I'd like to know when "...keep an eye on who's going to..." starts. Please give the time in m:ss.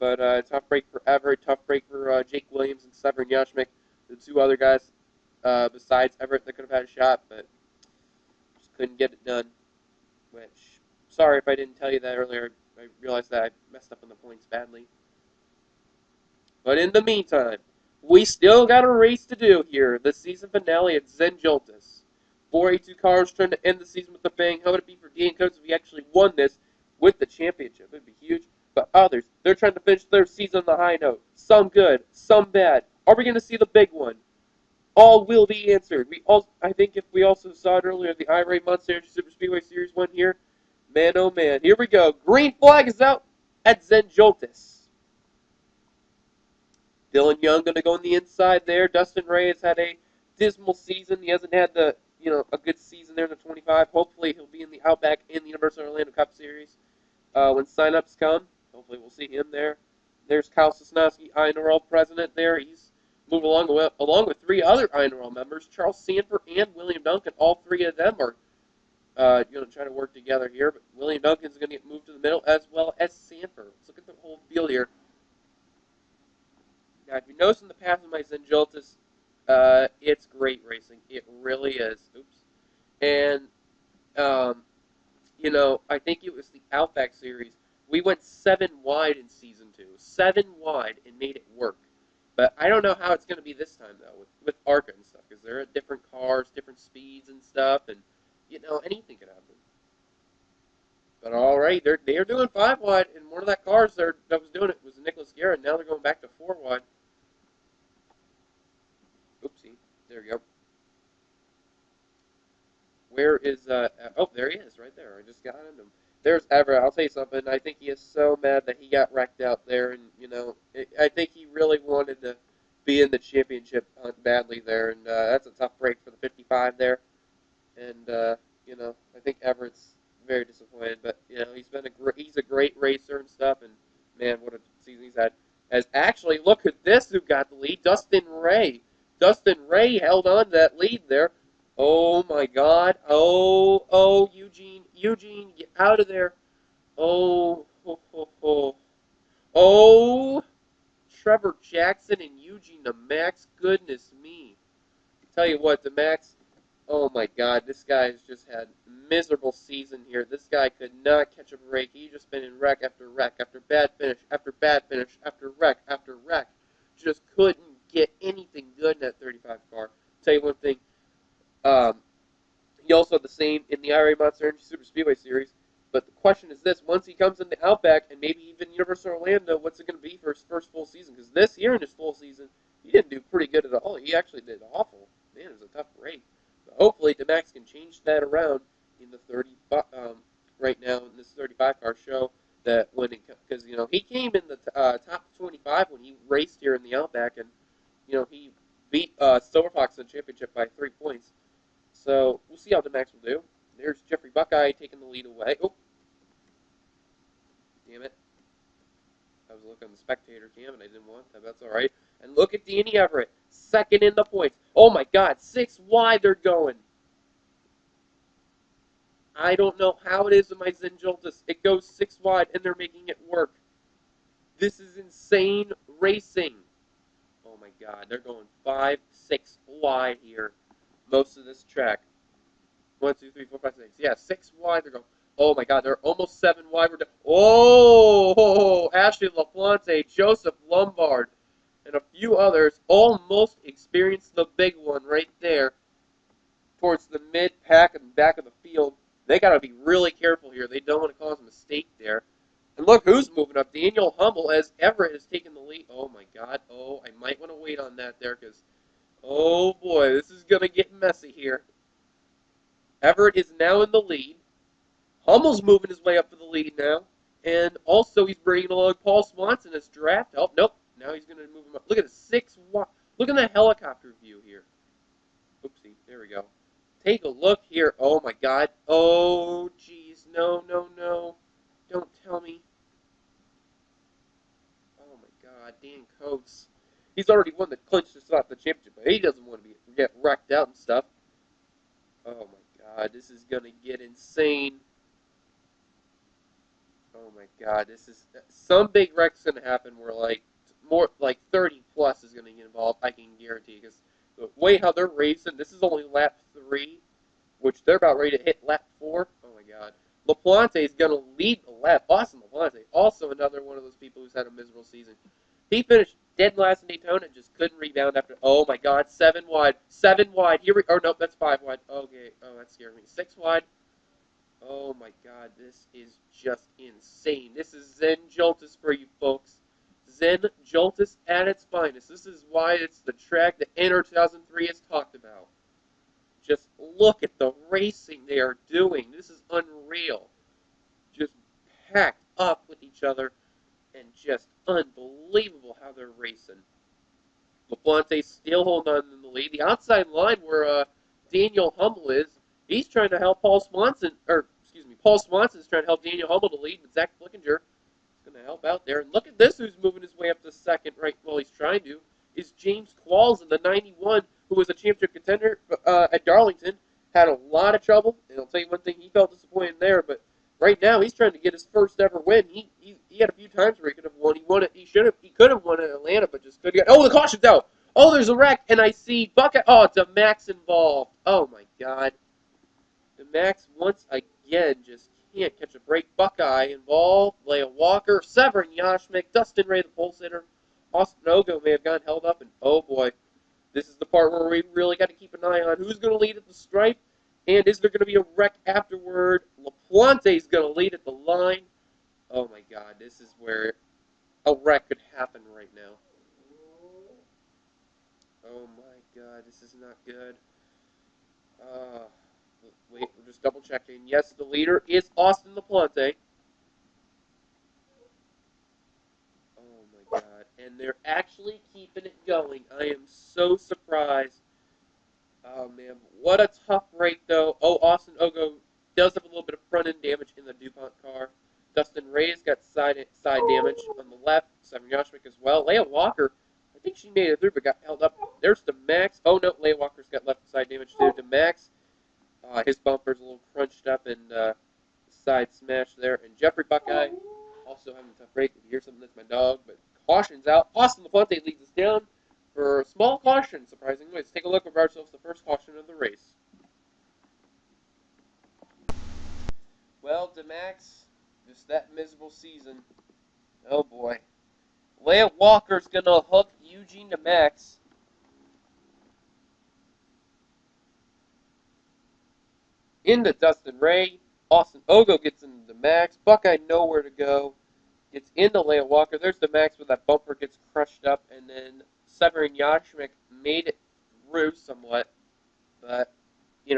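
6:35.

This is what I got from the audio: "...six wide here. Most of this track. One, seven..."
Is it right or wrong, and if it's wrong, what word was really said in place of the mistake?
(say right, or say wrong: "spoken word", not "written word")
wrong: "two", not "seven".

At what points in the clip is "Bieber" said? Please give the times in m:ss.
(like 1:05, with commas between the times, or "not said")
not said.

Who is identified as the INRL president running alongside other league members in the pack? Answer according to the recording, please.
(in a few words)
Kyle Sosnowski.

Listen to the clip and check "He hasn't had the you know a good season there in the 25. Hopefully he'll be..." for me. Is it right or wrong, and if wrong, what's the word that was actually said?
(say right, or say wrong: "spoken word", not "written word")
right.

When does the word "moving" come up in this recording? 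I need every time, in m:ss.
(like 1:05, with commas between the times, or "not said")
4:13, 4:25, 5:59.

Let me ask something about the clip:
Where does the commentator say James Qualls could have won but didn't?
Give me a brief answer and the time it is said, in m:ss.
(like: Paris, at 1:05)
Atlanta, at 6:15.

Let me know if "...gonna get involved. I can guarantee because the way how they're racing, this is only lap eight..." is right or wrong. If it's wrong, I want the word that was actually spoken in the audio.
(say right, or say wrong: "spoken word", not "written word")
wrong: "three", not "eight".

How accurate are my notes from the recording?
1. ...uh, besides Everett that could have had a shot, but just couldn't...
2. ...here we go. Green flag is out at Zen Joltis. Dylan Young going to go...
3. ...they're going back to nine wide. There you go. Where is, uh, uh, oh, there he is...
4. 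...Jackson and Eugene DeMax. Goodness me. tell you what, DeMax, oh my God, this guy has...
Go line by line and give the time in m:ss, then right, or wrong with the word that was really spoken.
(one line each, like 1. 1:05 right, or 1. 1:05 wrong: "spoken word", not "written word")
1. 0:05 right
2. 0:41 right
3. 1:45 wrong: "four", not "nine"
4. 2:31 right.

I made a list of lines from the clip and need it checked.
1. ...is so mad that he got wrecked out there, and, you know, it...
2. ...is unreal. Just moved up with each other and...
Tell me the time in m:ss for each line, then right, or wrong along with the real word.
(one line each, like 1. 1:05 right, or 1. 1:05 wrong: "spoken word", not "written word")
1. 1:57 right
2. 5:39 wrong: "packed", not "moved".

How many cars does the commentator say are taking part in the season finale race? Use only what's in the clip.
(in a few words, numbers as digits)
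482.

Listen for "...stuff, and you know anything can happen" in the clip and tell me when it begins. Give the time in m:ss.
1:37.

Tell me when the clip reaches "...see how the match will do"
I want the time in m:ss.
3:22.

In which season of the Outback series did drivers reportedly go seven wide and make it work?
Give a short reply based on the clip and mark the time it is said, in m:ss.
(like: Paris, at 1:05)
season two, at 1:29.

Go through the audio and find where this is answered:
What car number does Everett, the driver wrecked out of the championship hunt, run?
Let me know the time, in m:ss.
2:06.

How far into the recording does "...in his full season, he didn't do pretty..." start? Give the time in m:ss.
3:01.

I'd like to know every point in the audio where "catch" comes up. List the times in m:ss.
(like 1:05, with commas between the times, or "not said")
2:41, 6:25.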